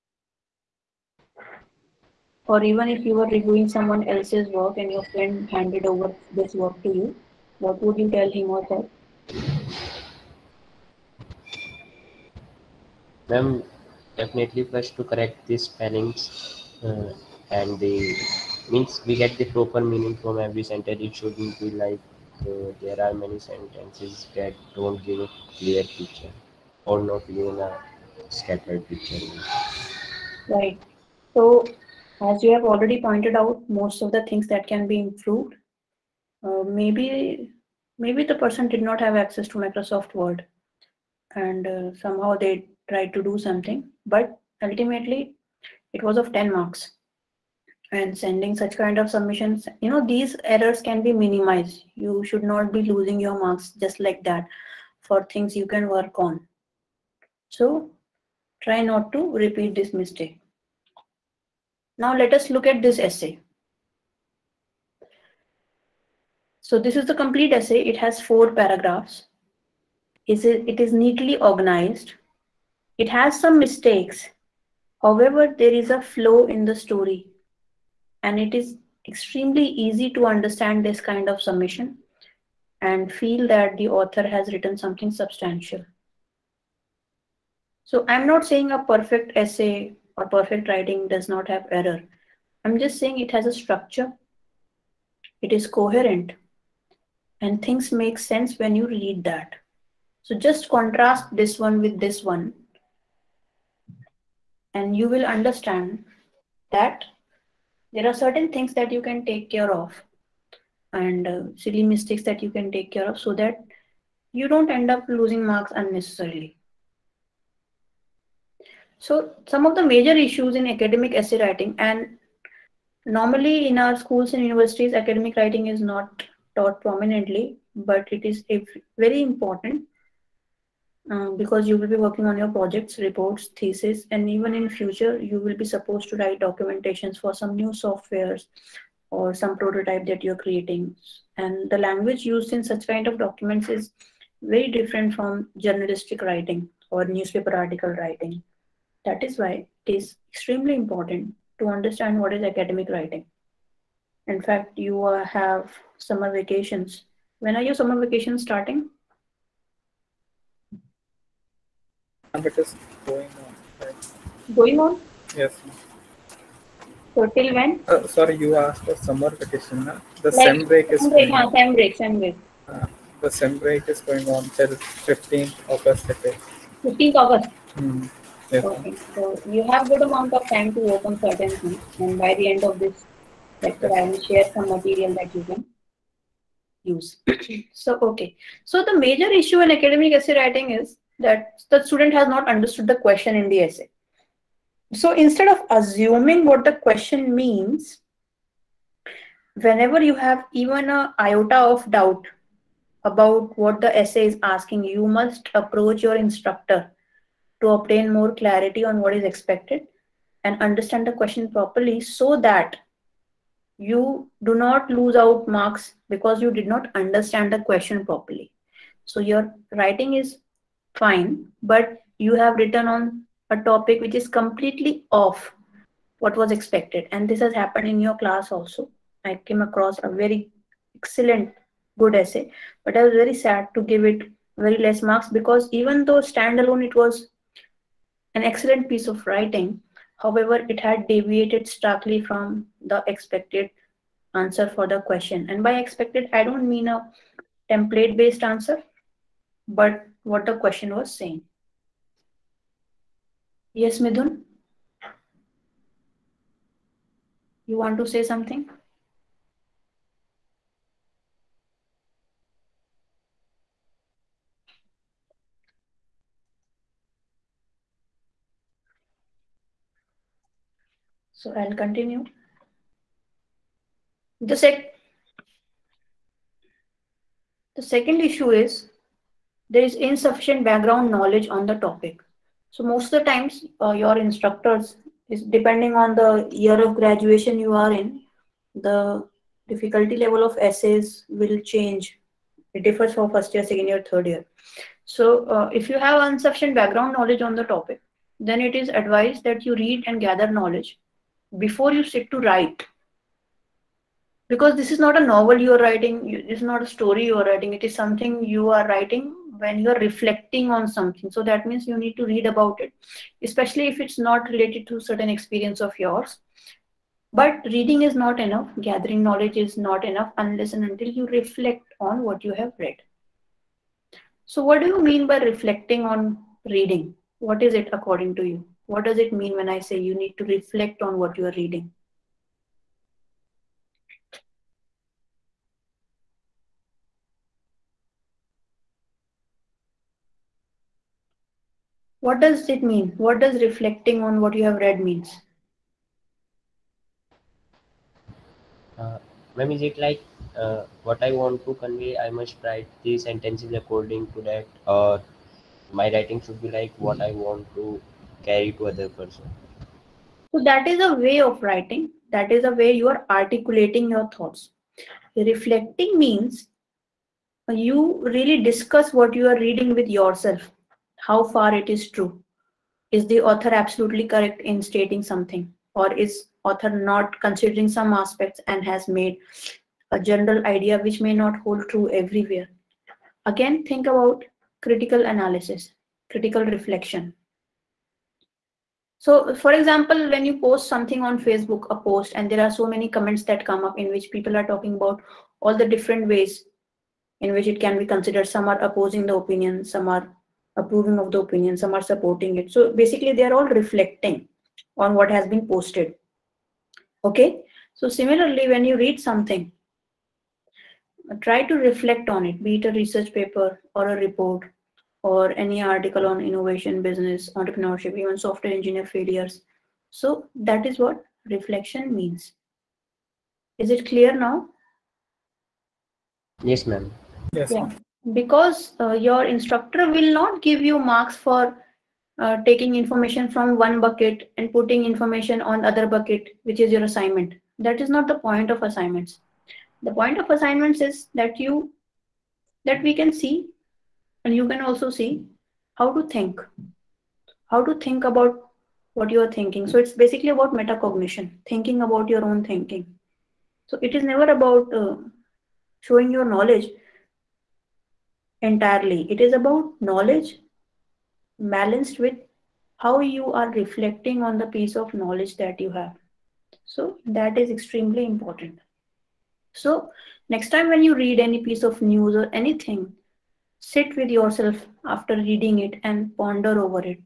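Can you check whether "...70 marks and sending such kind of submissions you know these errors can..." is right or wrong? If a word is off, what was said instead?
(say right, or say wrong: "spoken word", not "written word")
wrong: "10", not "70".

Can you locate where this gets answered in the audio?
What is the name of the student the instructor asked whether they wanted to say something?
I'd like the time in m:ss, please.
4:13.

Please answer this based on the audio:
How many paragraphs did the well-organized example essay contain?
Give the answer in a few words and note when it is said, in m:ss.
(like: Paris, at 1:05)
4, at 1:08.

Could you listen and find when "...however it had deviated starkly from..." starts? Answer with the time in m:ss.
4:00.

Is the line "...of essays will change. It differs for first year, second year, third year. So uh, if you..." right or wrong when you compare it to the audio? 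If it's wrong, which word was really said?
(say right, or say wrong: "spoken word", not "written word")
right.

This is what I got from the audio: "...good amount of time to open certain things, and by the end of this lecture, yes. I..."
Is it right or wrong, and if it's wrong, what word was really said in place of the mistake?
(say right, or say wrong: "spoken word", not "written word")
right.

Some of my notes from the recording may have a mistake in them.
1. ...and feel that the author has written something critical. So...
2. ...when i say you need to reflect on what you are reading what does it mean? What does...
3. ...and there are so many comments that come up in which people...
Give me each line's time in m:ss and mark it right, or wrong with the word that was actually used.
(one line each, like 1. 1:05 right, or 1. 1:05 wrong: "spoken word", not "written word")
1. 1:22 wrong: "substantial", not "critical"
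2. 5:29 right
3. 6:32 right.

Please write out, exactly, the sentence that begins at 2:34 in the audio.
In fact, you uh, have summer vacations.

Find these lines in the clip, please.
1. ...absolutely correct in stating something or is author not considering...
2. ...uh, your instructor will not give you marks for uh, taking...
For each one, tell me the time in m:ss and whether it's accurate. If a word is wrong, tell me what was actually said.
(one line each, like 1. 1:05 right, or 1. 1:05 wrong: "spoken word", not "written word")
1. 6:13 right
2. 7:08 right.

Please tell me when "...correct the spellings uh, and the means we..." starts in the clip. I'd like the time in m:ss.
0:15.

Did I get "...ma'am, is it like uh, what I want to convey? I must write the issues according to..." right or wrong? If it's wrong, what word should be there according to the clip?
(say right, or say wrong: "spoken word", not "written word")
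wrong: "sentences", not "issues".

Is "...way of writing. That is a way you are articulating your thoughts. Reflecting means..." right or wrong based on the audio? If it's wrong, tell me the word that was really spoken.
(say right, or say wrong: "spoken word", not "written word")
right.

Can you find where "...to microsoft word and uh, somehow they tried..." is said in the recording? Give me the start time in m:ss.
0:39.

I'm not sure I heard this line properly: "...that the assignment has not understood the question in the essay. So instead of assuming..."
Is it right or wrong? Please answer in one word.
wrong.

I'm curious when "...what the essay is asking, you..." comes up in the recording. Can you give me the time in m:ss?
3:23.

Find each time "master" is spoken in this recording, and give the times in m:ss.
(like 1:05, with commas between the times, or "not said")
not said.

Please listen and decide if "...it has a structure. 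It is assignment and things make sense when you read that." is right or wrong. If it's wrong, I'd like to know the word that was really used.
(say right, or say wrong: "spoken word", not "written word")
wrong: "coherent", not "assignment".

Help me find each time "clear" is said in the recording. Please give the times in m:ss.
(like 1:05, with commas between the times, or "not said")
0:25, 7:04.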